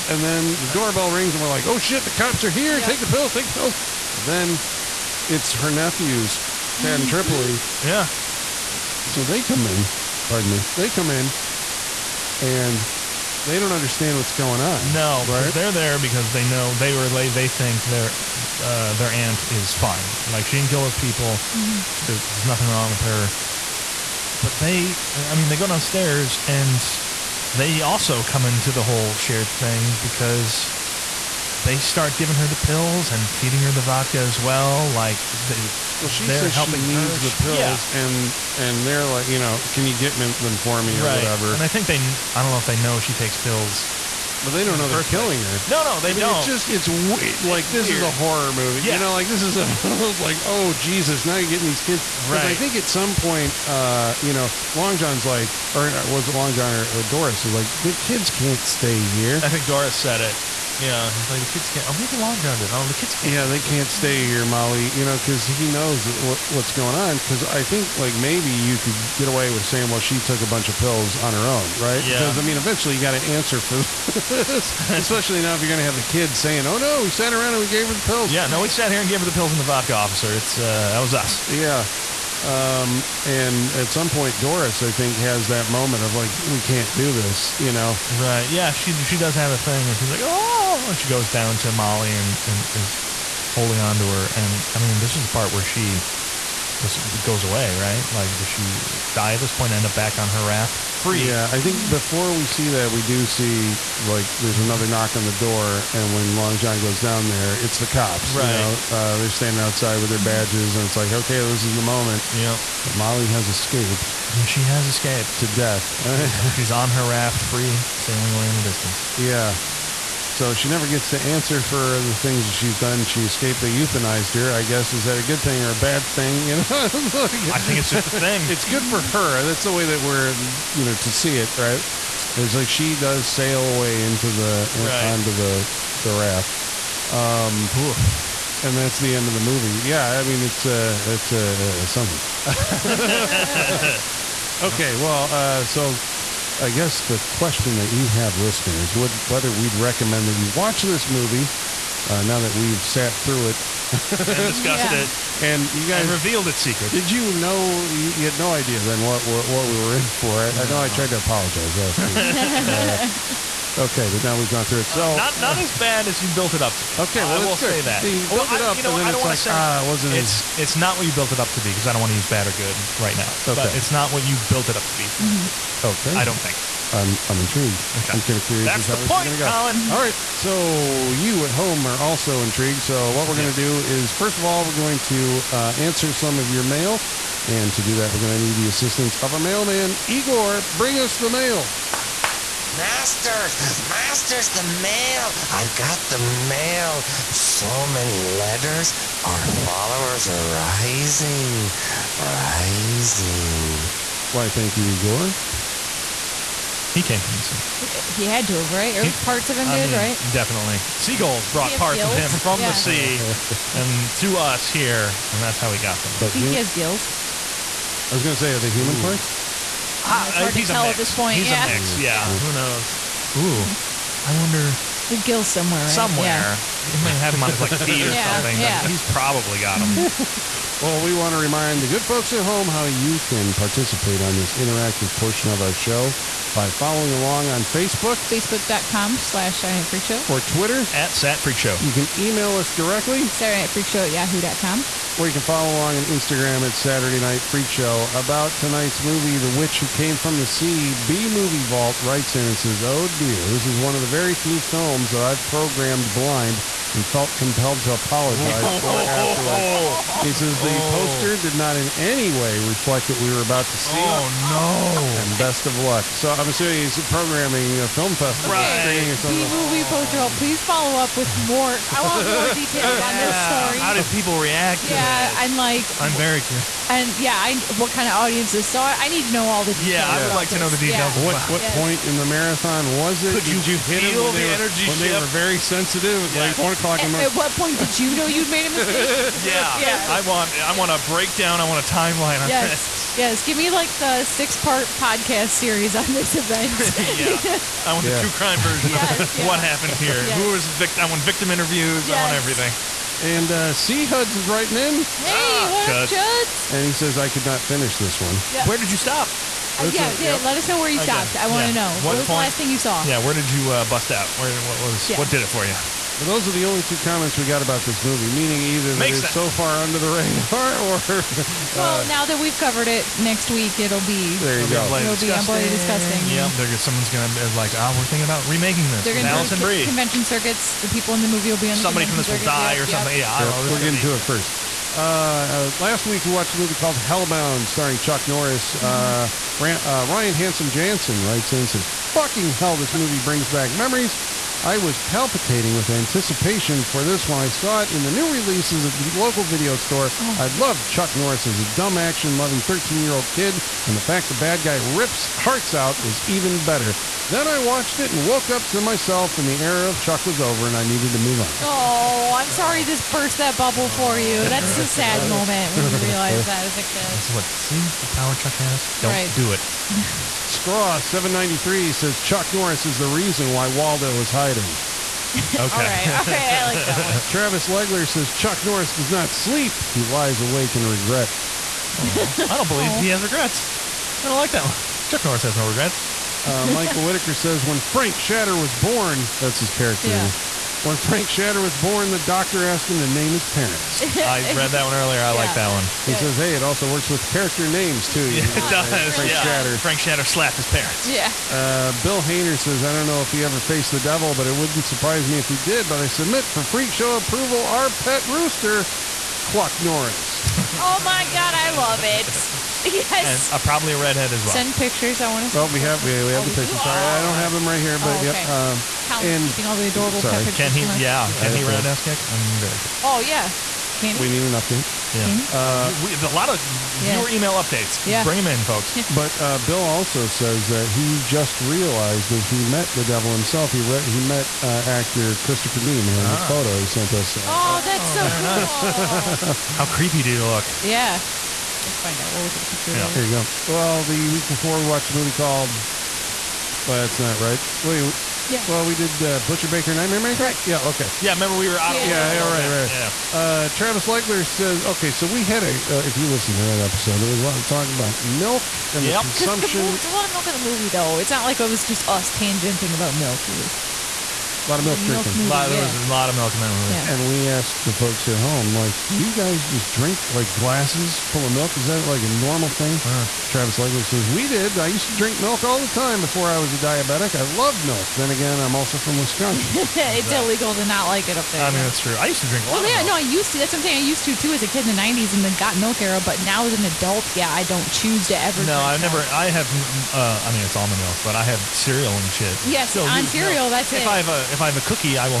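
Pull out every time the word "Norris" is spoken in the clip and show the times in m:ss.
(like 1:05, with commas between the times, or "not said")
5:38, 5:51, 6:12, 6:18, 6:25, 6:49.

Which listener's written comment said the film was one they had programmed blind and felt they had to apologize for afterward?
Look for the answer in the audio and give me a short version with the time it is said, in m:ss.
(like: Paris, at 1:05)
B Movie Vault, at 4:10.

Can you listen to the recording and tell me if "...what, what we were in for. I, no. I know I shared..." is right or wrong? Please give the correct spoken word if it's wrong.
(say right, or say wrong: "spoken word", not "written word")
wrong: "tried", not "shared".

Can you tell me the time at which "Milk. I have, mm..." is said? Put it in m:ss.
8:09.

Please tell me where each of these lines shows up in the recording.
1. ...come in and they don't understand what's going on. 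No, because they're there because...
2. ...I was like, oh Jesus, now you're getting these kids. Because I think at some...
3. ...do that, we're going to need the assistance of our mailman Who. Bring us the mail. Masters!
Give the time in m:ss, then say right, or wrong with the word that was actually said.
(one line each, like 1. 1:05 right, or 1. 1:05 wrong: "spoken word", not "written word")
1. 0:10 right
2. 0:49 right
3. 3:07 wrong: "Igor", not "Who".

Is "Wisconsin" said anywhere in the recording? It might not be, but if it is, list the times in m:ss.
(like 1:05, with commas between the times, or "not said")
7:59.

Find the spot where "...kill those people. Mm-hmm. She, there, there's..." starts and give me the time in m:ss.
0:20.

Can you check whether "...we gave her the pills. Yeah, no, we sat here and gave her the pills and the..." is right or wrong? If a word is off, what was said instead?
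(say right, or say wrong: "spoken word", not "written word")
right.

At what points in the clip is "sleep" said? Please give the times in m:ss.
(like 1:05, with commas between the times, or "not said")
6:19.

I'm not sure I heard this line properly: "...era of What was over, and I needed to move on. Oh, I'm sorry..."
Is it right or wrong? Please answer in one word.
wrong.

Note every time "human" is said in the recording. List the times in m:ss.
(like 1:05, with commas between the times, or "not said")
3:38.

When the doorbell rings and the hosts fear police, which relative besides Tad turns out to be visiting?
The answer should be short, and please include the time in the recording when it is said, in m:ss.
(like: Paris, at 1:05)
Tripoli, at 0:07.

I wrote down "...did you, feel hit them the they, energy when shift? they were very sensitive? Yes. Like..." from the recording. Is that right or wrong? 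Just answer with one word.
right.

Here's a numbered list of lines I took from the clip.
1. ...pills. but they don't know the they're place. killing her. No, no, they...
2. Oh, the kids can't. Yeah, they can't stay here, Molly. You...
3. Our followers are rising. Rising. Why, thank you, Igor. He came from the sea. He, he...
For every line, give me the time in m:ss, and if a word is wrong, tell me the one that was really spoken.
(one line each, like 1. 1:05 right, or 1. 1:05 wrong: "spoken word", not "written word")
1. 0:43 right
2. 1:02 right
3. 3:19 right.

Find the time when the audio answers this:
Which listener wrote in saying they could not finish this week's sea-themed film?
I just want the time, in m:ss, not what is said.
5:03.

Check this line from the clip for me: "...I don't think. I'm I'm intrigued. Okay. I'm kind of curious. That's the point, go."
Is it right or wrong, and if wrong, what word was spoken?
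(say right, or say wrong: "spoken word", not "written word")
right.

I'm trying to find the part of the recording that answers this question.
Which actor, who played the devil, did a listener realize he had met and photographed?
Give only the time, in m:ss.
7:15.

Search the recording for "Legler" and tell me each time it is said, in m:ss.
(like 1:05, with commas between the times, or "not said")
6:17, 7:34, 7:53.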